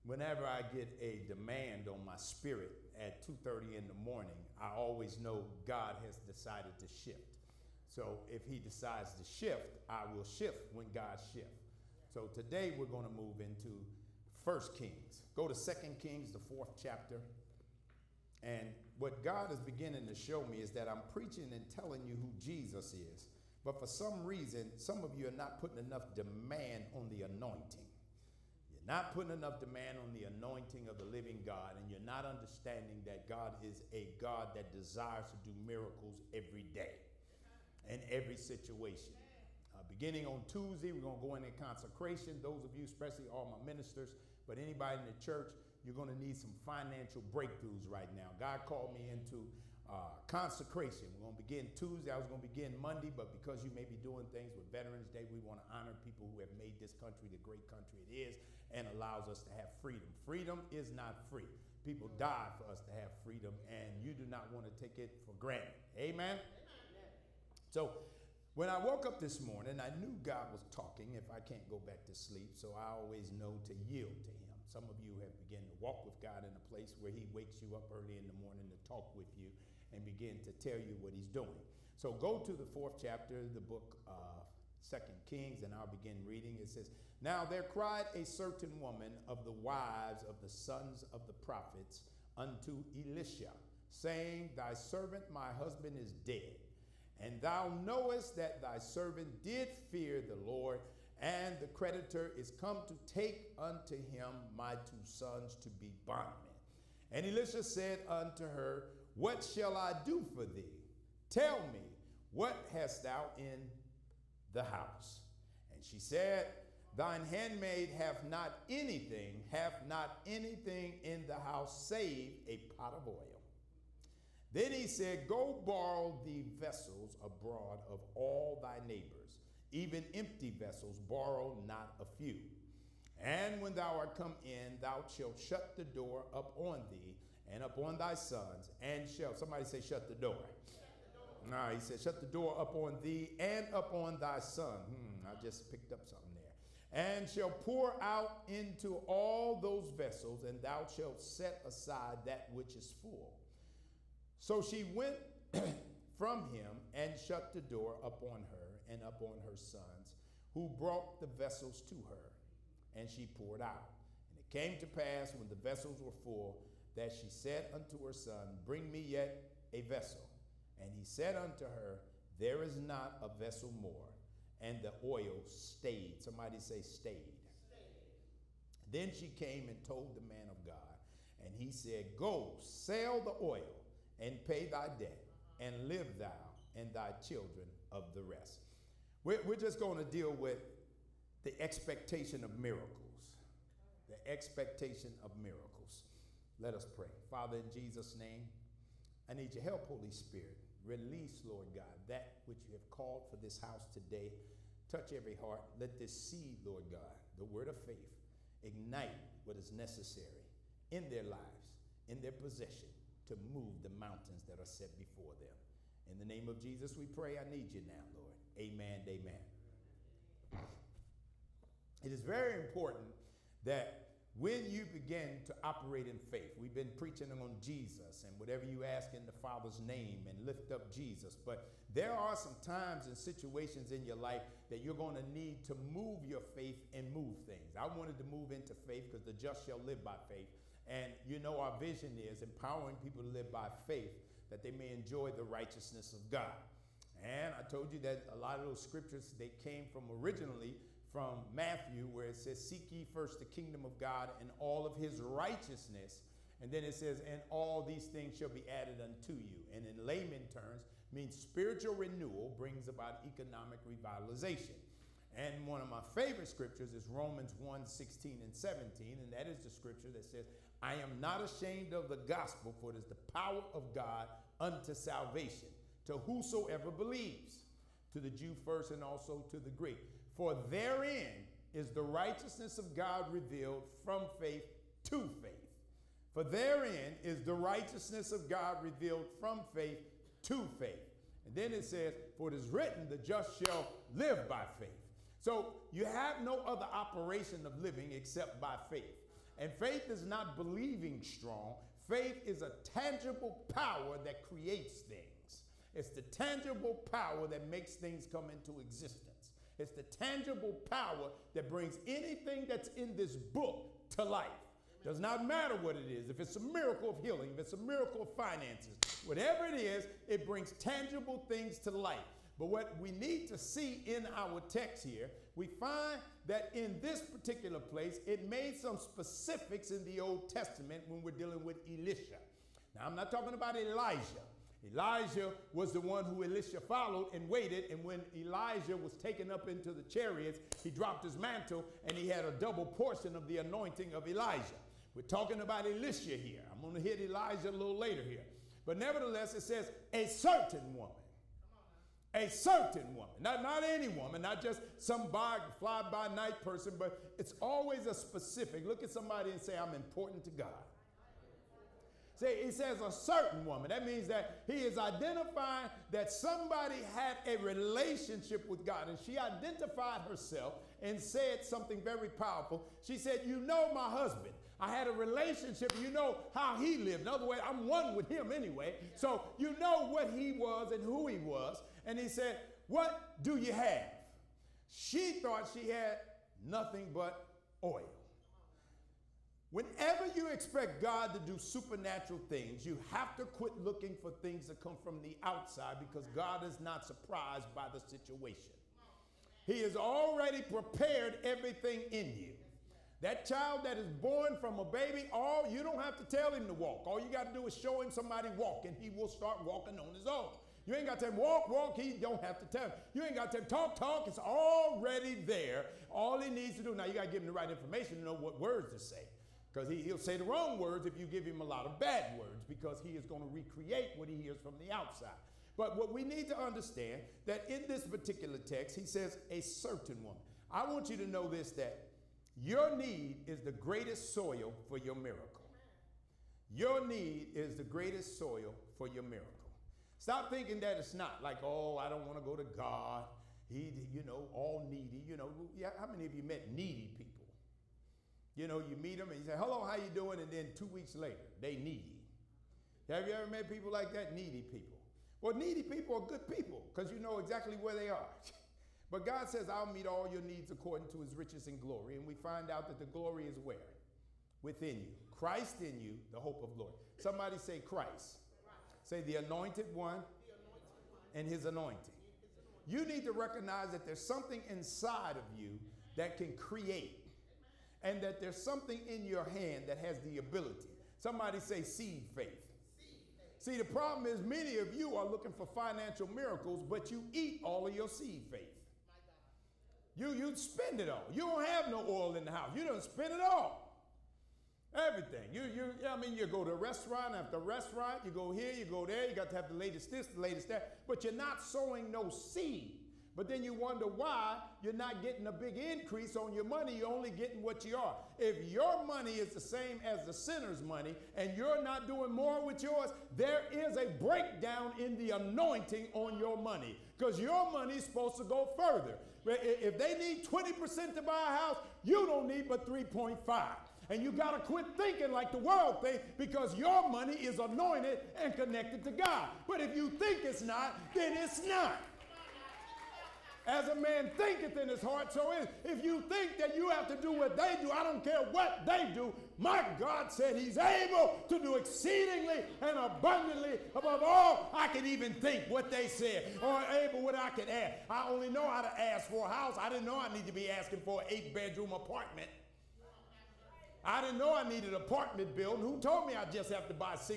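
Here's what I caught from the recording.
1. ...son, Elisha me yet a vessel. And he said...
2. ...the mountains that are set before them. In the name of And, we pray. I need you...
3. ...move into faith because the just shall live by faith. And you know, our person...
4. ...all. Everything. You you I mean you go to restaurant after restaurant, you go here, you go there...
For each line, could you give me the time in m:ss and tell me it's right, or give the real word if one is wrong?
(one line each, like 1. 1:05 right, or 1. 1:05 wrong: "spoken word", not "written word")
1. 2:48 wrong: "Bring", not "Elisha"
2. 3:33 wrong: "Jesus", not "And"
3. 3:58 wrong: "vision", not "person"
4. 8:13 right.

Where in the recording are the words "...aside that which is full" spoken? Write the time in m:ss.
2:31.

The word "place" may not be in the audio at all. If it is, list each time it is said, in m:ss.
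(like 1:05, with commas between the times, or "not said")
1:16, 5:27.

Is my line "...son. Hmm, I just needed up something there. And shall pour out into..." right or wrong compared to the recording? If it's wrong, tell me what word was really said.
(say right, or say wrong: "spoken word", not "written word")
wrong: "picked", not "needed".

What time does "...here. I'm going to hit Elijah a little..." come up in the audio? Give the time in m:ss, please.
5:46.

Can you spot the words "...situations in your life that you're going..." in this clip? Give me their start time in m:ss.
3:53.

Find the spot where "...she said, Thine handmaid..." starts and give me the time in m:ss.
1:55.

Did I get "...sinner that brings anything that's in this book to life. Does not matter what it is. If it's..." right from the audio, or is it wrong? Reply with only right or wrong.
wrong.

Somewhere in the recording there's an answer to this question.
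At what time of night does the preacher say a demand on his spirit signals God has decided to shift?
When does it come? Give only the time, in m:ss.
0:03.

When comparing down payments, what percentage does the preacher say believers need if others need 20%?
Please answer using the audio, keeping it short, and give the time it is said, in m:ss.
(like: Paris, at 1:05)
3.5%, at 8:42.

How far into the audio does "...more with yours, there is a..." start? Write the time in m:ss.
8:32.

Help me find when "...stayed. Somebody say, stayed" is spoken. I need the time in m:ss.
2:55.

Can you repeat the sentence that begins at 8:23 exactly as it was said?
But then you wonder why you're not getting a big increase on your money.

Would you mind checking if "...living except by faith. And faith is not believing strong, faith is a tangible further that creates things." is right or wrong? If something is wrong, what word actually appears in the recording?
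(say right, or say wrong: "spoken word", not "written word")
wrong: "power", not "further".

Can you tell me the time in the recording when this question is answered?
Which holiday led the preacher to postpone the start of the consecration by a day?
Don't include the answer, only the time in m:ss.
0:54.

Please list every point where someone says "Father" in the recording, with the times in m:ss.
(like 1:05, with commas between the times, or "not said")
3:17, 3:49.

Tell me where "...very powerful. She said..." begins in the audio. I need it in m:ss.
6:12.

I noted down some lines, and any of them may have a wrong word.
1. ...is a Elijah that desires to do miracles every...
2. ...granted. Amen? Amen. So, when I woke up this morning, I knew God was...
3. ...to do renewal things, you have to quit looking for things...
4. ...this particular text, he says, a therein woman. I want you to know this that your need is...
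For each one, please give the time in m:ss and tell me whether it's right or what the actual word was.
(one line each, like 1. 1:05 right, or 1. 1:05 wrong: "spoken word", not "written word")
1. 0:33 wrong: "God", not "Elijah"
2. 1:05 right
3. 6:31 wrong: "supernatural", not "renewal"
4. 7:07 wrong: "certain", not "therein".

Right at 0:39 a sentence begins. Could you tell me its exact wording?
Uh, beginning on Tuesday, we're going to go into consecration.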